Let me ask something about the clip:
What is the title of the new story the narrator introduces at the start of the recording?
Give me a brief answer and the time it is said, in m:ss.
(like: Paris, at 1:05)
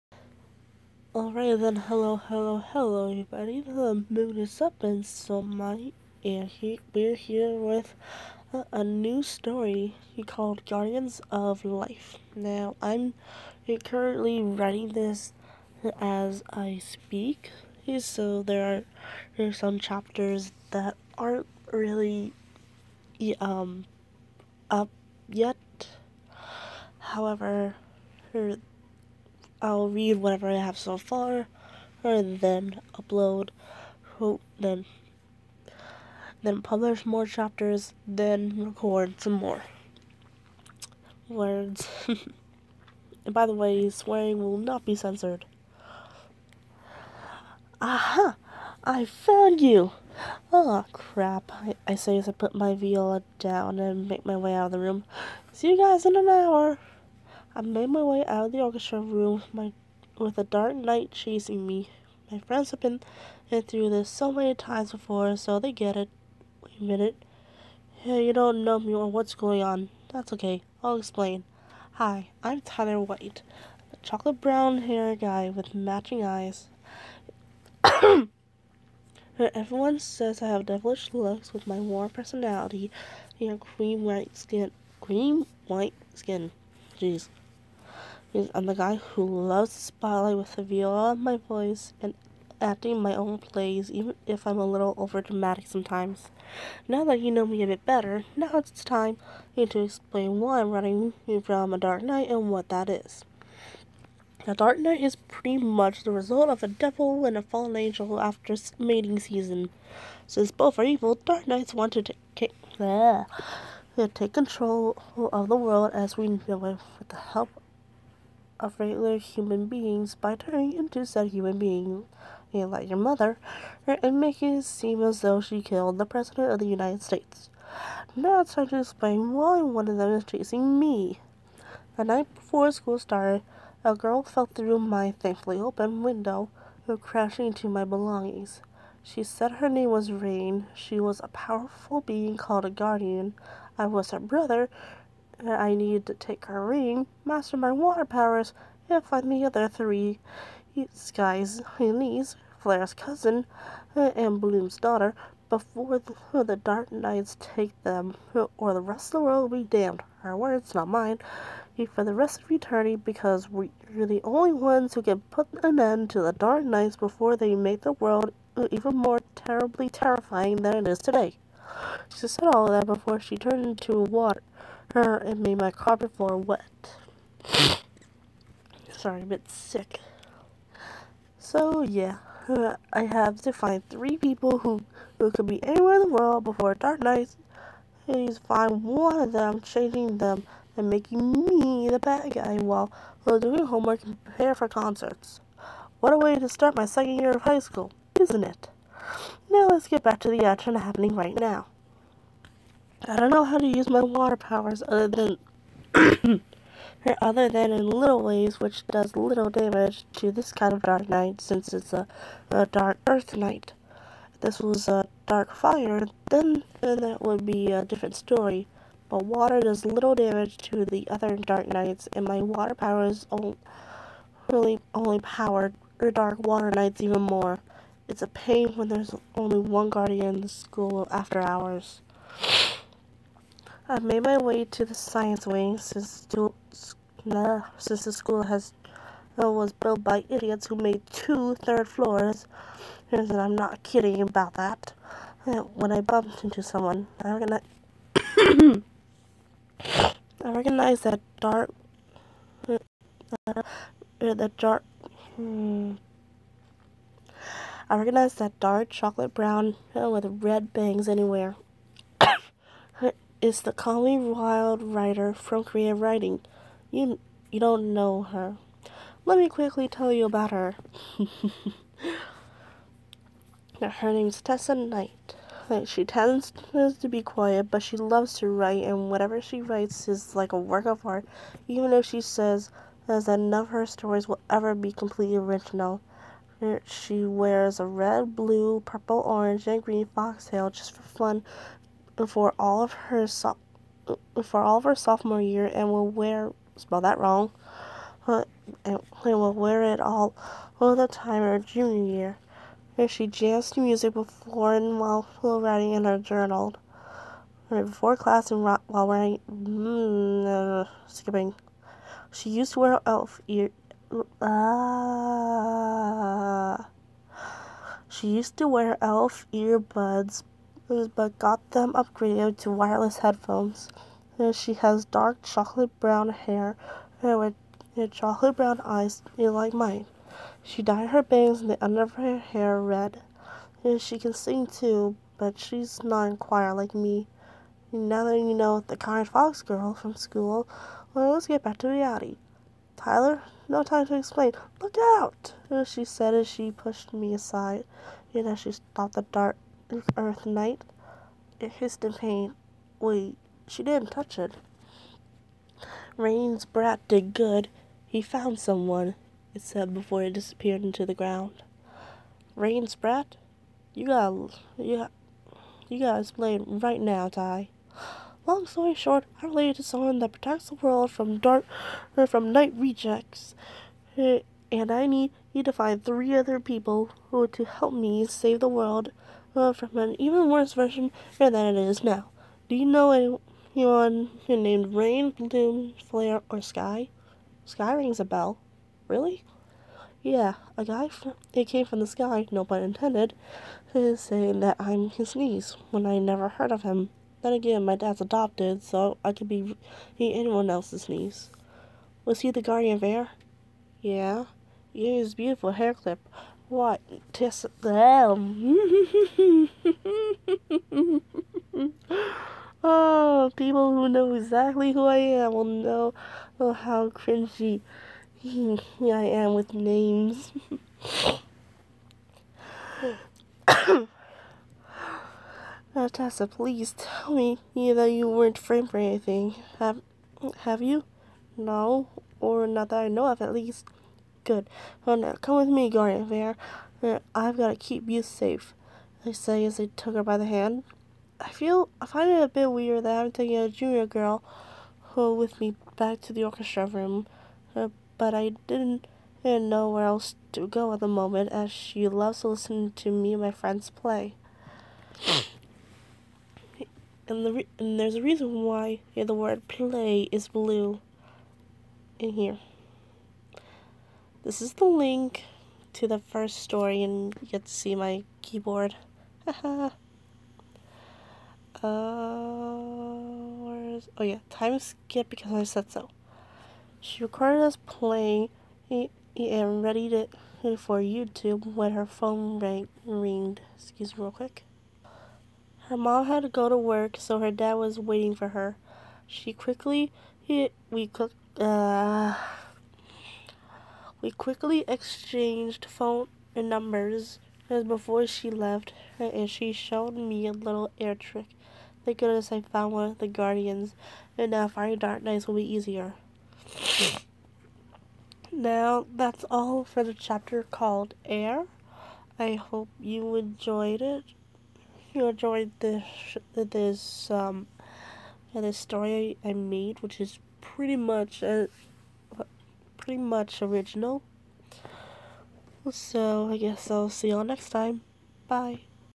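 Guardians of Life, at 0:10.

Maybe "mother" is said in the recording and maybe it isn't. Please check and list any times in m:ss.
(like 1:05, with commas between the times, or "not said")
2:02.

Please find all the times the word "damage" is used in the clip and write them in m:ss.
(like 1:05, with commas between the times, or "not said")
3:29, 3:40.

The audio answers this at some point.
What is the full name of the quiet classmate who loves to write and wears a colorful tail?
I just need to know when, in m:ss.
4:34.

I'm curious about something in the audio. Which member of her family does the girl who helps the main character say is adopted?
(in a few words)
her dad.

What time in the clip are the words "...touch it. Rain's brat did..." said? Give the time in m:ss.
5:54.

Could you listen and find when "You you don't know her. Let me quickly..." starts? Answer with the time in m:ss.
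4:26.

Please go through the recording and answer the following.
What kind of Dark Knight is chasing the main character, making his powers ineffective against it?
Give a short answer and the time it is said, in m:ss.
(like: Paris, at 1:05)
Dark Earth Knight, at 3:32.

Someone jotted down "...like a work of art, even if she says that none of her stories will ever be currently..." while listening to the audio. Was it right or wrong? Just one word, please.
wrong.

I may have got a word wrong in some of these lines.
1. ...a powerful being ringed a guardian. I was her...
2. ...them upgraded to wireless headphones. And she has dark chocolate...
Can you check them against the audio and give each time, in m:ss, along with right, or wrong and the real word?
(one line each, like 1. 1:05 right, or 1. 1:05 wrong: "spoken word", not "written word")
1. 2:21 wrong: "called", not "ringed"
2. 5:21 right.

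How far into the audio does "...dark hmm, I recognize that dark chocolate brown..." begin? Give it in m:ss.
4:14.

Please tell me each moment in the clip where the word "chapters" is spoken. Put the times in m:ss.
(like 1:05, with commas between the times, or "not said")
0:19, 0:37, 8:30.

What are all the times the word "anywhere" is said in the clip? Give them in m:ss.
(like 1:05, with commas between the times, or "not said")
3:05, 4:21.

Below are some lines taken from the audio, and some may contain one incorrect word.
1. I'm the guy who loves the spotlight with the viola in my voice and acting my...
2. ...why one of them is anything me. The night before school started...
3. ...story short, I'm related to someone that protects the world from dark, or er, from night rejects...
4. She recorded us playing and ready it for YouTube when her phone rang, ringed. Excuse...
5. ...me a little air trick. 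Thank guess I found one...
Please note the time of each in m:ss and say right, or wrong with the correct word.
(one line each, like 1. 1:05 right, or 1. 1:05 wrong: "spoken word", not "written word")
1. 1:28 right
2. 2:09 wrong: "chasing", not "anything"
3. 6:08 right
4. 7:57 right
5. 8:20 wrong: "goodness", not "guess".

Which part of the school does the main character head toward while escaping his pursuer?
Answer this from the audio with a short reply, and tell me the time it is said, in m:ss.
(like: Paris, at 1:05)
science wing, at 3:54.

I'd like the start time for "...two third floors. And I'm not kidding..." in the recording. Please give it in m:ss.
4:01.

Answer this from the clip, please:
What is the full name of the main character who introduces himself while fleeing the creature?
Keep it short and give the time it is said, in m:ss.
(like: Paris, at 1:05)
Tyler White, at 1:12.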